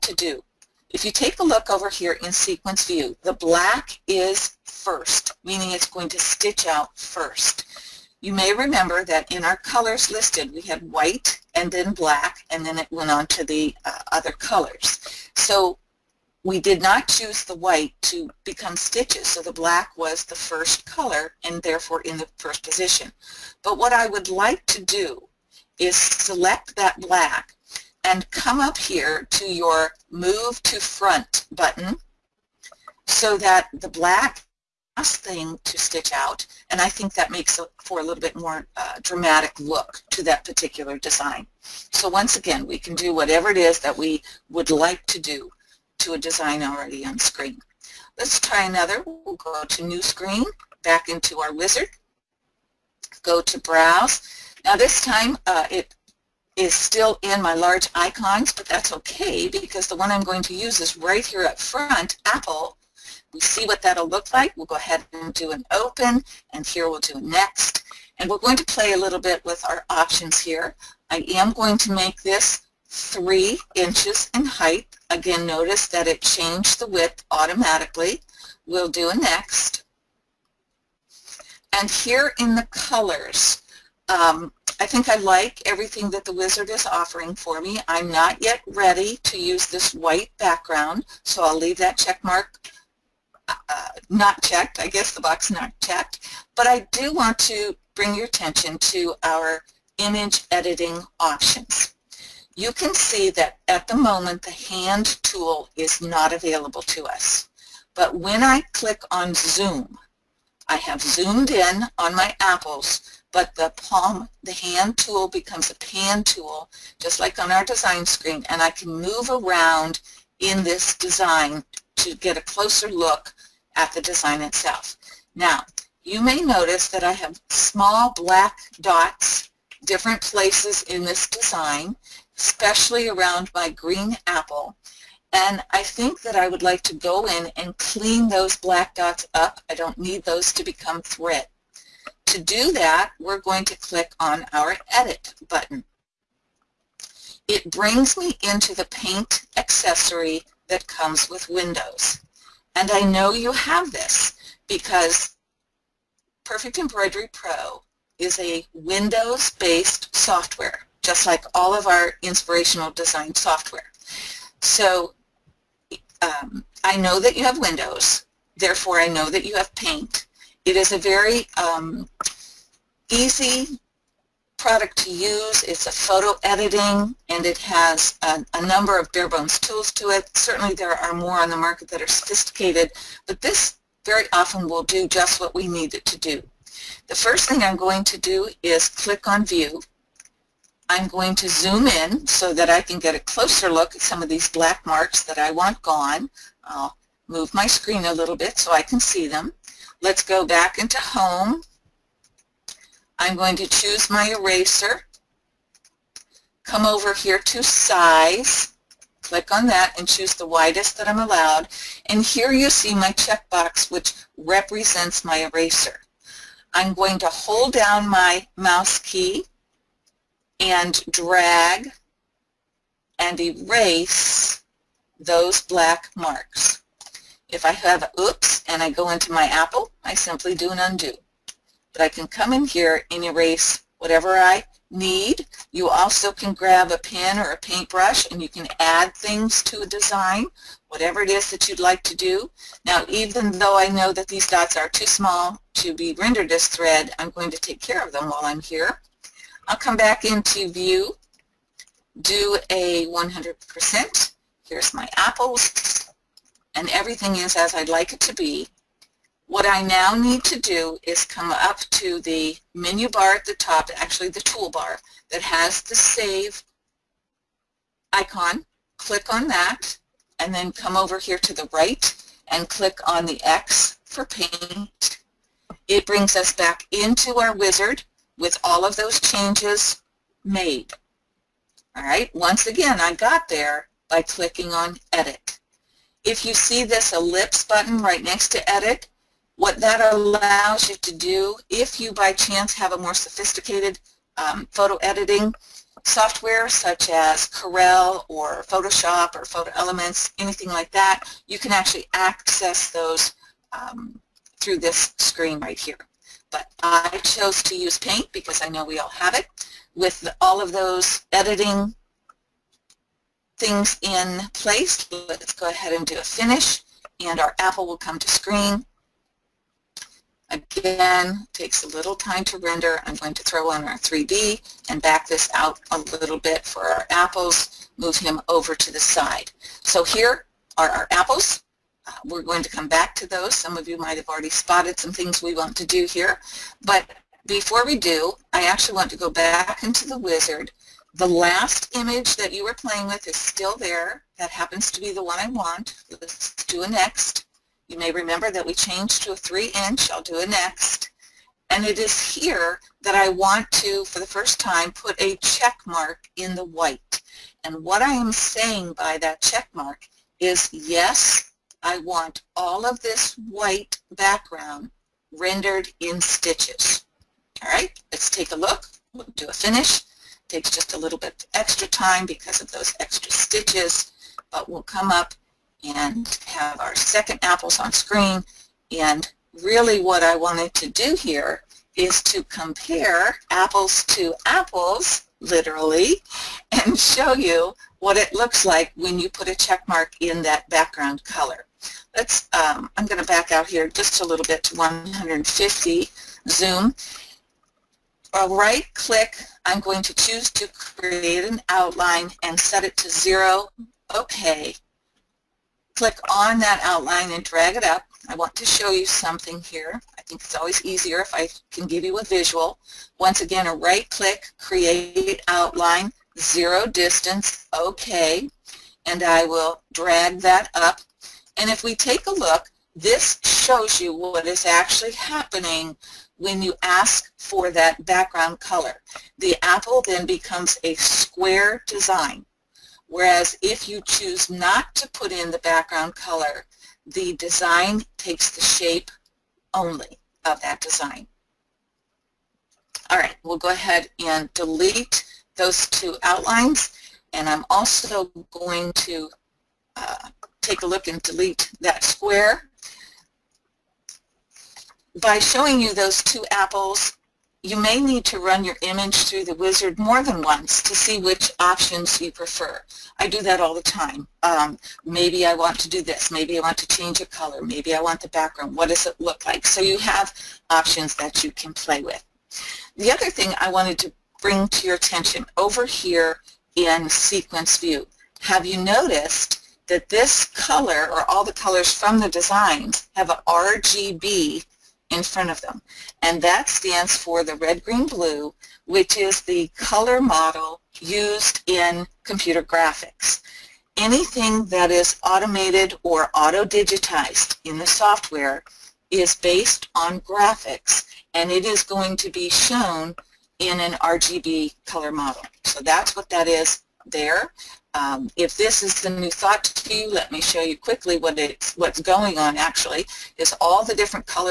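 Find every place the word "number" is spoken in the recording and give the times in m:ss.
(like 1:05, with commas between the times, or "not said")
2:58.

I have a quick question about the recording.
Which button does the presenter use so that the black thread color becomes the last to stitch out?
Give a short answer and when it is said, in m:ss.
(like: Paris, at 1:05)
Move to Front, at 0:30.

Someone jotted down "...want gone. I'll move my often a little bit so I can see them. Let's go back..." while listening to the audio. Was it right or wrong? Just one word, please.
wrong.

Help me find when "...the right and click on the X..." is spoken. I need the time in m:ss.
4:31.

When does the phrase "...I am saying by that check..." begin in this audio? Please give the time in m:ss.
5:58.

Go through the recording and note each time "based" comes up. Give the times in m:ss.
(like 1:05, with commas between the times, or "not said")
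2:38, 8:19.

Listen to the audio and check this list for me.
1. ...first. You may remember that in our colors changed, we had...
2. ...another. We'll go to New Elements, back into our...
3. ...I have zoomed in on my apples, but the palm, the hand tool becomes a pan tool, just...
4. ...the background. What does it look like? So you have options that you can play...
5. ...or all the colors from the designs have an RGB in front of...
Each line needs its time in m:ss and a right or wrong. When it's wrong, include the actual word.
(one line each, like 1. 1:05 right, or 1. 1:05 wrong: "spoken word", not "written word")
1. 0:06 wrong: "listed", not "changed"
2. 0:48 wrong: "Screen", not "Elements"
3. 1:50 right
4. 7:48 right
5. 8:01 right.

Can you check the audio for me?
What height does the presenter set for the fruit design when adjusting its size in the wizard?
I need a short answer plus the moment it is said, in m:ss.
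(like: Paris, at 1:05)
3 inches, at 1:12.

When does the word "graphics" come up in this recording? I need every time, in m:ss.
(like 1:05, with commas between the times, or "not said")
8:12, 8:20.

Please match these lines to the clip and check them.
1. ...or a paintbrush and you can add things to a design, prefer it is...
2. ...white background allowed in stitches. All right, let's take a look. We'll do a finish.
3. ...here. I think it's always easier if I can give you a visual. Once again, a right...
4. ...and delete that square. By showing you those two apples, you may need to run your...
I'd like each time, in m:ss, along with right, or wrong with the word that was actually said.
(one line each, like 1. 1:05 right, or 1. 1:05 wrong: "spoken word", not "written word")
1. 3:57 wrong: "whatever", not "prefer"
2. 6:03 wrong: "rendered", not "allowed"
3. 6:49 right
4. 7:31 right.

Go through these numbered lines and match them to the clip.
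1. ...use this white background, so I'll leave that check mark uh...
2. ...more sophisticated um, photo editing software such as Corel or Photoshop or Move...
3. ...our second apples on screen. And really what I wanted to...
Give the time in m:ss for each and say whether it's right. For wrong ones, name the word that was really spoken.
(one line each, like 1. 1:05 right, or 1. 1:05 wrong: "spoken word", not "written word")
1. 1:29 right
2. 4:52 wrong: "Photo", not "Move"
3. 6:16 right.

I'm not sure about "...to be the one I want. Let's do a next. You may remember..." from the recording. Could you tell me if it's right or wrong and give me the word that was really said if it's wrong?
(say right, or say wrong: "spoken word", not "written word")
right.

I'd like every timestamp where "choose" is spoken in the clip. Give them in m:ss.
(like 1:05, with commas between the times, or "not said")
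0:17, 3:23, 3:30, 6:40, 7:14.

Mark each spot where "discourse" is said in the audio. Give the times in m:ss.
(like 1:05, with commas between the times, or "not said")
not said.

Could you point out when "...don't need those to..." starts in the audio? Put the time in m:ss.
2:19.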